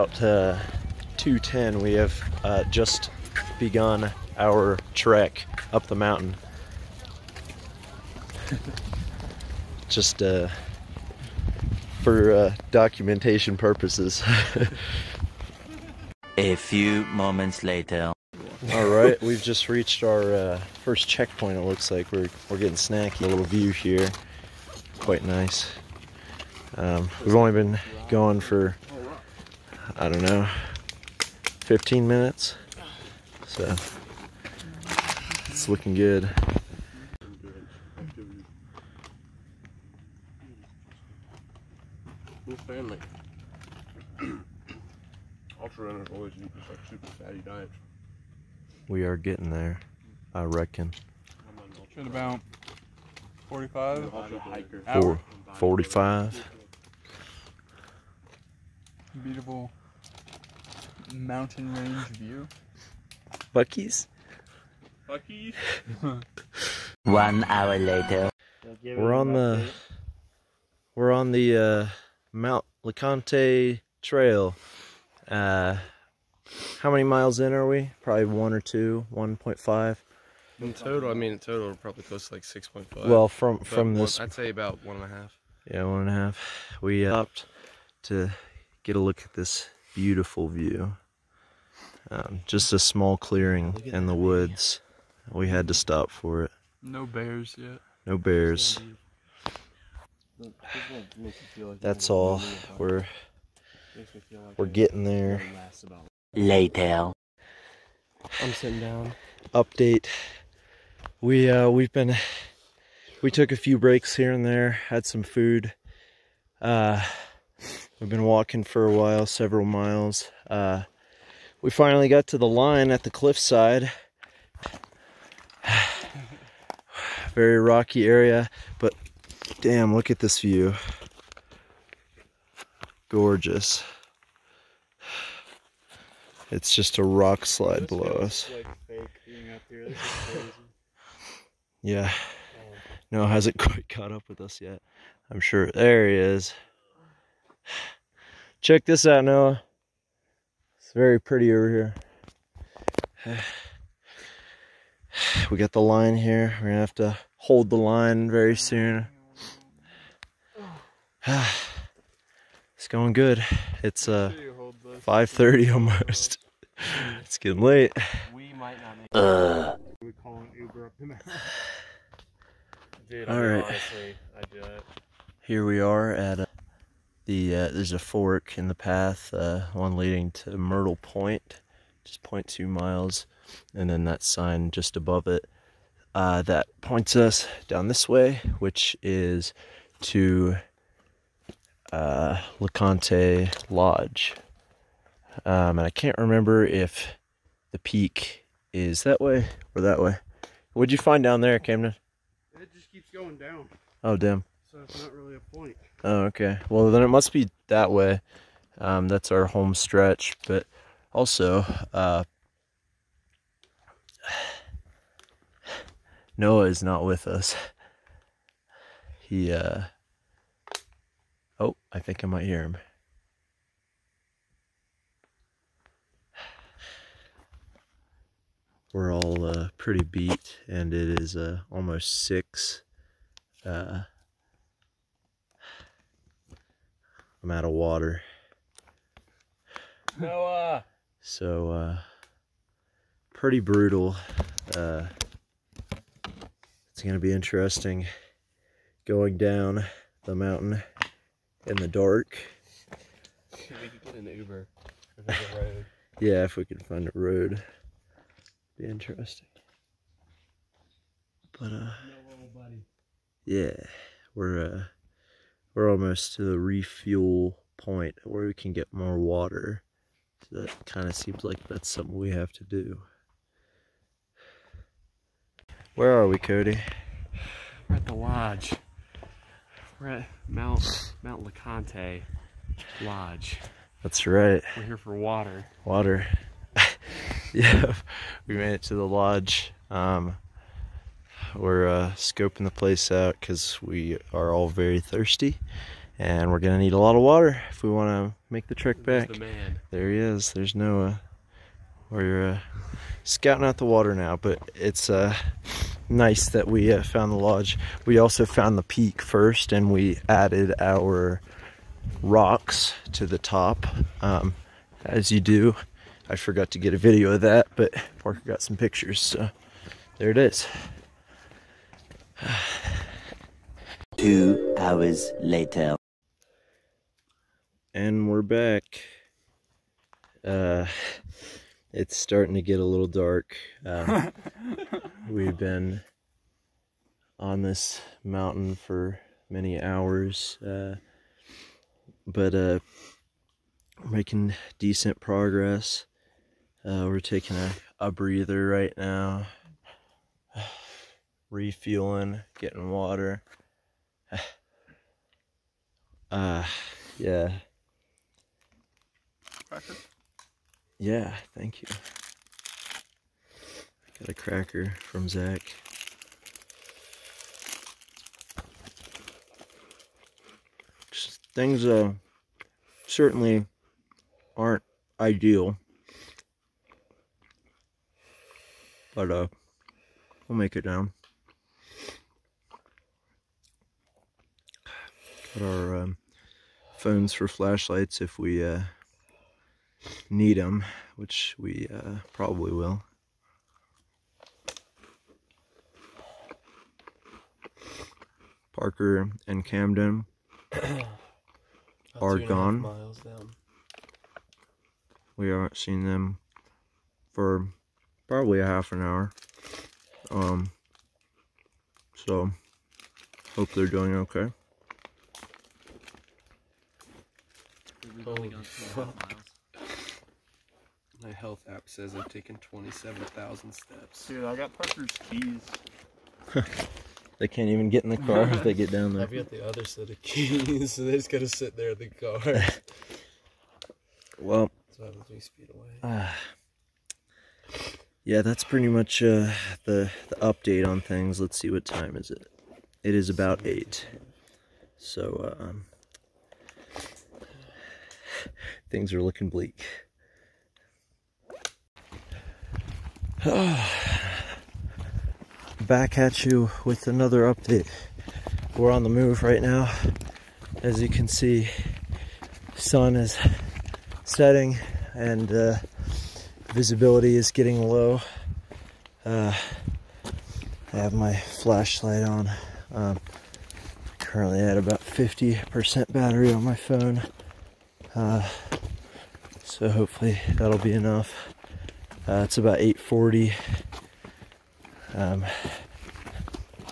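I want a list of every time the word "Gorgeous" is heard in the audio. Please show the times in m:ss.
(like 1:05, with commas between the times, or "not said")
2:13.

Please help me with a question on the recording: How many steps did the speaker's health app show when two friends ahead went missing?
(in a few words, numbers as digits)
27,000.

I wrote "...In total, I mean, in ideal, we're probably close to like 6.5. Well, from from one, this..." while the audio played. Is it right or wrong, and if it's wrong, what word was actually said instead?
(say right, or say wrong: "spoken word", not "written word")
wrong: "total", not "ideal".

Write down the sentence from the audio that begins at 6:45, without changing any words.
We haven't seen them for probably a half an hour.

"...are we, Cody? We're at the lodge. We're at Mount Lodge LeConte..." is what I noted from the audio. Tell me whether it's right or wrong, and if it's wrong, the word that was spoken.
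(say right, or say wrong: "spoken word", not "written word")
wrong: "Mount", not "Lodge".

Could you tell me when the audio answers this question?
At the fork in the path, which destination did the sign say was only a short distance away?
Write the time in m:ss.
3:00.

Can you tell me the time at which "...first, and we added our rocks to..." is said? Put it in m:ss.
5:09.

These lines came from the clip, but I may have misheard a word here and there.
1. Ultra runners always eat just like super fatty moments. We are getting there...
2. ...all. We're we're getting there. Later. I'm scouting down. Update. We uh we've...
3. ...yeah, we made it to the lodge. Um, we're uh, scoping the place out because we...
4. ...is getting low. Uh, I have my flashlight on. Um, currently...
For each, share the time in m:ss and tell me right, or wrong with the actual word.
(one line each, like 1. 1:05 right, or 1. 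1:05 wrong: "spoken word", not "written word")
1. 0:45 wrong: "diets", not "moments"
2. 1:42 wrong: "sitting", not "scouting"
3. 4:47 right
4. 7:47 right.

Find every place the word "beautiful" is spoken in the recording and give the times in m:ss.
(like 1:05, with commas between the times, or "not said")
0:59, 1:29.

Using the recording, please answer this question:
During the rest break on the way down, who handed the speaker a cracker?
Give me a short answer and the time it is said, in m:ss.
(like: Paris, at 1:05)
Zach, at 6:05.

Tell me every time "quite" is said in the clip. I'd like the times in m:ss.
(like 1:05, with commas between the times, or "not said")
0:24, 2:23.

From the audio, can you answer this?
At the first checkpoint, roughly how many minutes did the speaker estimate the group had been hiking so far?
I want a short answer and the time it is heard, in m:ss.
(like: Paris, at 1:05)
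15 minutes, at 0:31.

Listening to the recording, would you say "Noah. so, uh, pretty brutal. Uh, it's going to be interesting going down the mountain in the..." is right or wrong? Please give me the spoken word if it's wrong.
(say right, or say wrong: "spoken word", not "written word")
right.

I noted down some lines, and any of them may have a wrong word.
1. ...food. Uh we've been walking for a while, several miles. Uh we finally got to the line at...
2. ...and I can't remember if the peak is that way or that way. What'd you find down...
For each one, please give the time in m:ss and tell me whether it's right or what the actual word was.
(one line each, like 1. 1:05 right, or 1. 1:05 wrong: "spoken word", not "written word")
1. 1:55 right
2. 3:15 right.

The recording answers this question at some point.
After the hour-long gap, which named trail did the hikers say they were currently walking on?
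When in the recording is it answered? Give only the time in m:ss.
1:12.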